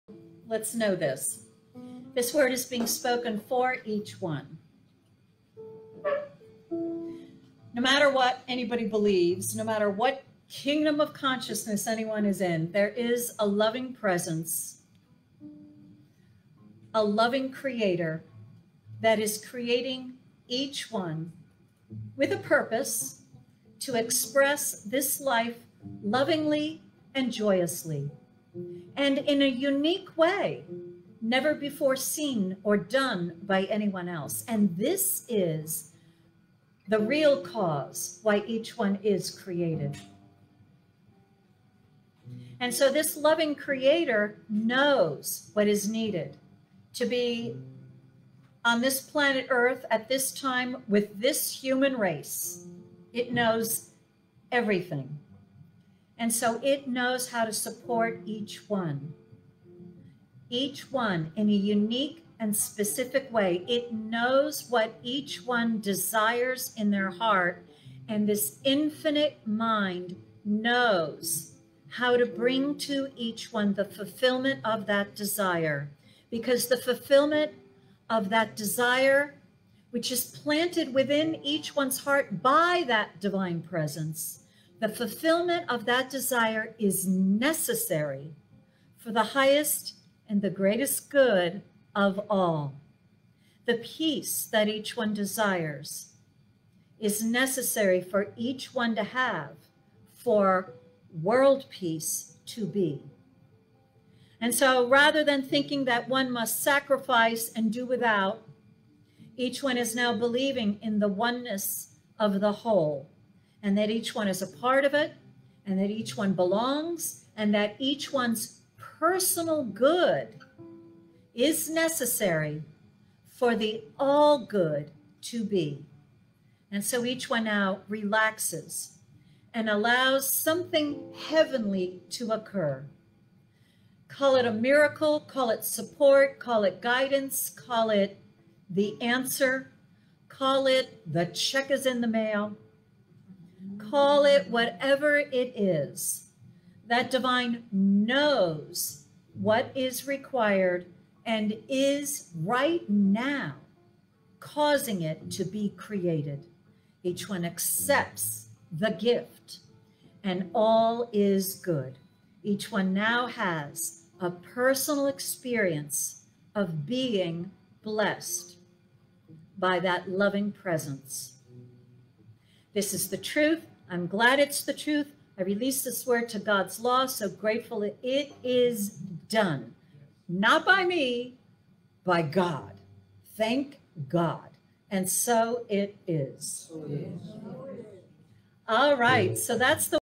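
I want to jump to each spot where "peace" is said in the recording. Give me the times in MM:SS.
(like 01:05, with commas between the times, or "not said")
01:33, 01:41.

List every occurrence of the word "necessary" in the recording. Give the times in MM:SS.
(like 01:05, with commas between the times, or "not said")
01:27, 01:37, 02:01.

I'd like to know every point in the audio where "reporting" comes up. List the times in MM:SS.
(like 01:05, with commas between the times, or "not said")
not said.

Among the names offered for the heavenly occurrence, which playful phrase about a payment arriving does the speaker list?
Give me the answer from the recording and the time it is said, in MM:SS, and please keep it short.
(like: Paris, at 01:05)
the check is in the mail, at 02:21.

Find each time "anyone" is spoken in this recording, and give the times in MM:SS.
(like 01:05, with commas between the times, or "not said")
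00:11, 00:33.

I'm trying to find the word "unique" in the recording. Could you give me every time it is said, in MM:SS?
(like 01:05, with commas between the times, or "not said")
00:29, 01:01.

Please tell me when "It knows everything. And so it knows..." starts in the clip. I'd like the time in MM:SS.
00:53.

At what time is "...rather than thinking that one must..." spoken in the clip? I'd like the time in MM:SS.
01:44.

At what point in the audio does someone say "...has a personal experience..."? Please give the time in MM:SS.
02:43.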